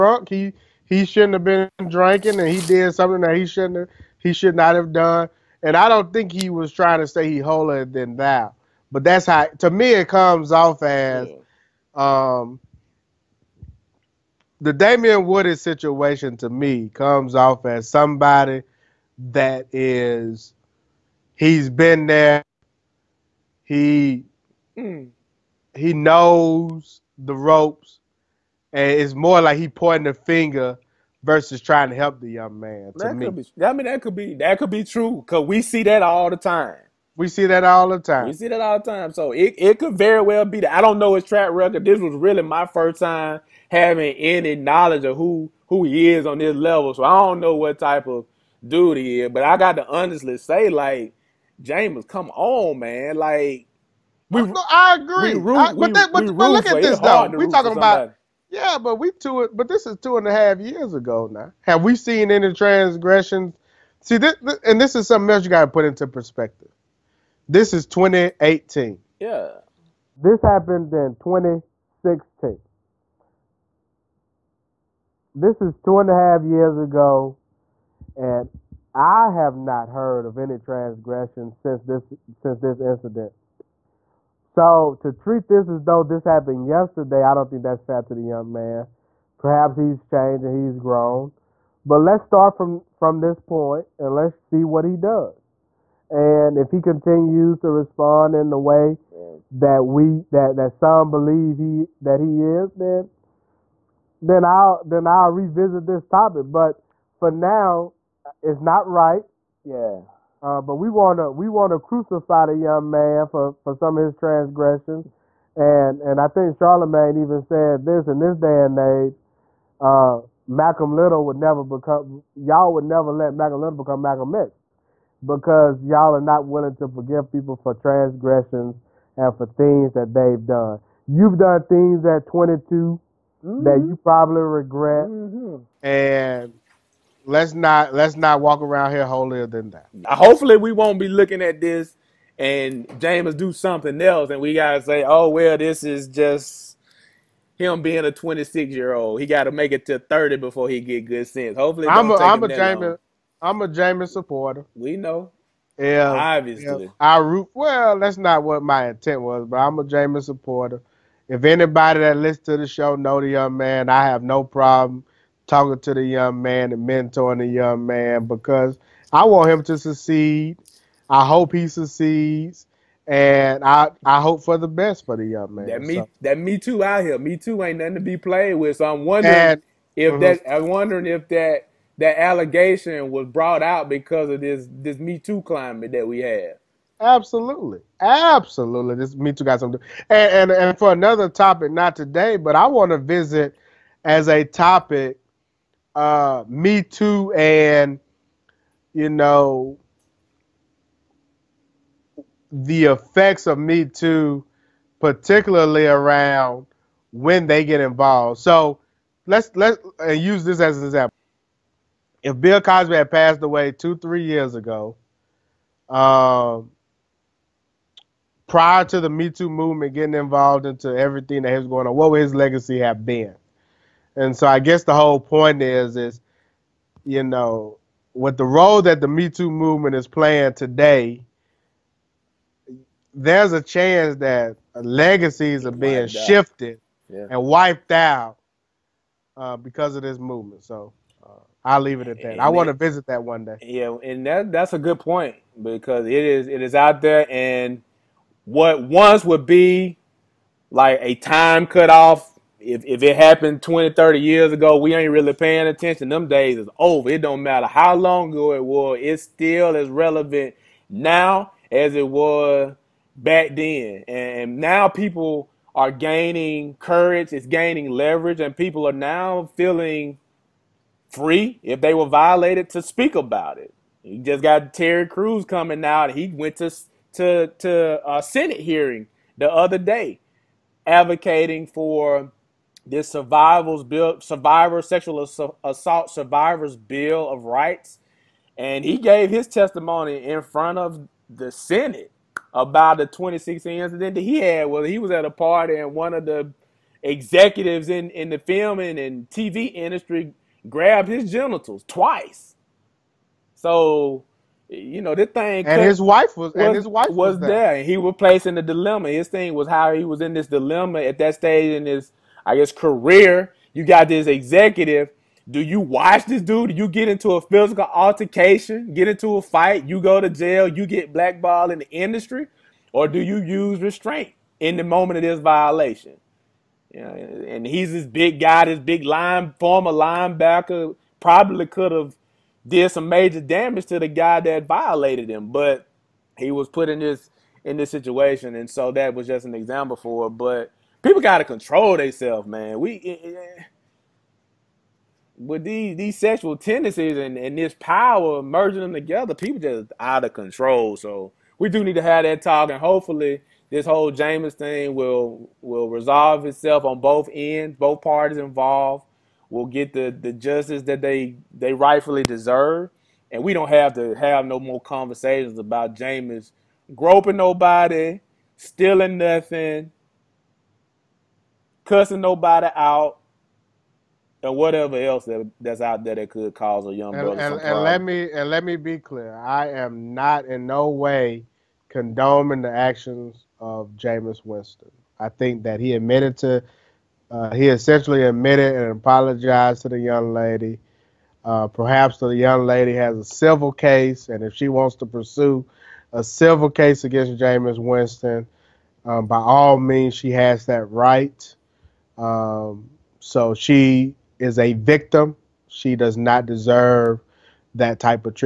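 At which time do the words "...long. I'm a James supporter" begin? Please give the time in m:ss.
2:32.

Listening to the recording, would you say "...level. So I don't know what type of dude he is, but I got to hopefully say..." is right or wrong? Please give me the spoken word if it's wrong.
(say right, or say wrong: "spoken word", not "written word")
wrong: "honestly", not "hopefully".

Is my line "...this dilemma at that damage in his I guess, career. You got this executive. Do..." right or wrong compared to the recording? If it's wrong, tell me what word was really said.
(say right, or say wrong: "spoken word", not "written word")
wrong: "stage", not "damage".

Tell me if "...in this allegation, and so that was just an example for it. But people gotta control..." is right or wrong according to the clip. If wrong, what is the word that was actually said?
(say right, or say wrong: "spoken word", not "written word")
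wrong: "situation", not "allegation".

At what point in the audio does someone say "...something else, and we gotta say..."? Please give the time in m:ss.
2:23.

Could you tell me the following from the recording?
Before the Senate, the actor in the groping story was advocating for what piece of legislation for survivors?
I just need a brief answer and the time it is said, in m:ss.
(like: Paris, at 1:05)
Sexual assault survivors bill of rights, at 4:44.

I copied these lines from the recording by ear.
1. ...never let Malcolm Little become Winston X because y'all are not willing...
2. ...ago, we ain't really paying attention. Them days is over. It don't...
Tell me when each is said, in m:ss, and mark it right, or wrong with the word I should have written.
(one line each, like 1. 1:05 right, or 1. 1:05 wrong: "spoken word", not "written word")
1. 2:02 wrong: "Malcolm", not "Winston"
2. 4:14 right.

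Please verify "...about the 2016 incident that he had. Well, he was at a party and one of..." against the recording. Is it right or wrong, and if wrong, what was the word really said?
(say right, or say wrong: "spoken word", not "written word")
right.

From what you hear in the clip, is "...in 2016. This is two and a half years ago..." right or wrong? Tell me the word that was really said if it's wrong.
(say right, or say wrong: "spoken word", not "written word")
right.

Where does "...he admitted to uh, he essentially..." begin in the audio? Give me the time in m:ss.
6:25.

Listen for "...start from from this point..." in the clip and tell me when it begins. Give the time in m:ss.
1:32.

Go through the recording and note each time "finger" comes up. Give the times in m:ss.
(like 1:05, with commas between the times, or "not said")
0:30.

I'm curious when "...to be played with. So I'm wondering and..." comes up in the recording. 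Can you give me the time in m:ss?
2:57.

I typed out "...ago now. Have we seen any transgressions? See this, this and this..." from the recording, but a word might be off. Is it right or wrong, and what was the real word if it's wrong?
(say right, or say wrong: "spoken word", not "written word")
right.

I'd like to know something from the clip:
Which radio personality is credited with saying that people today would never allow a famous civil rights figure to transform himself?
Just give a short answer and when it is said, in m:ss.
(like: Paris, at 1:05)
Charlemagne, at 1:56.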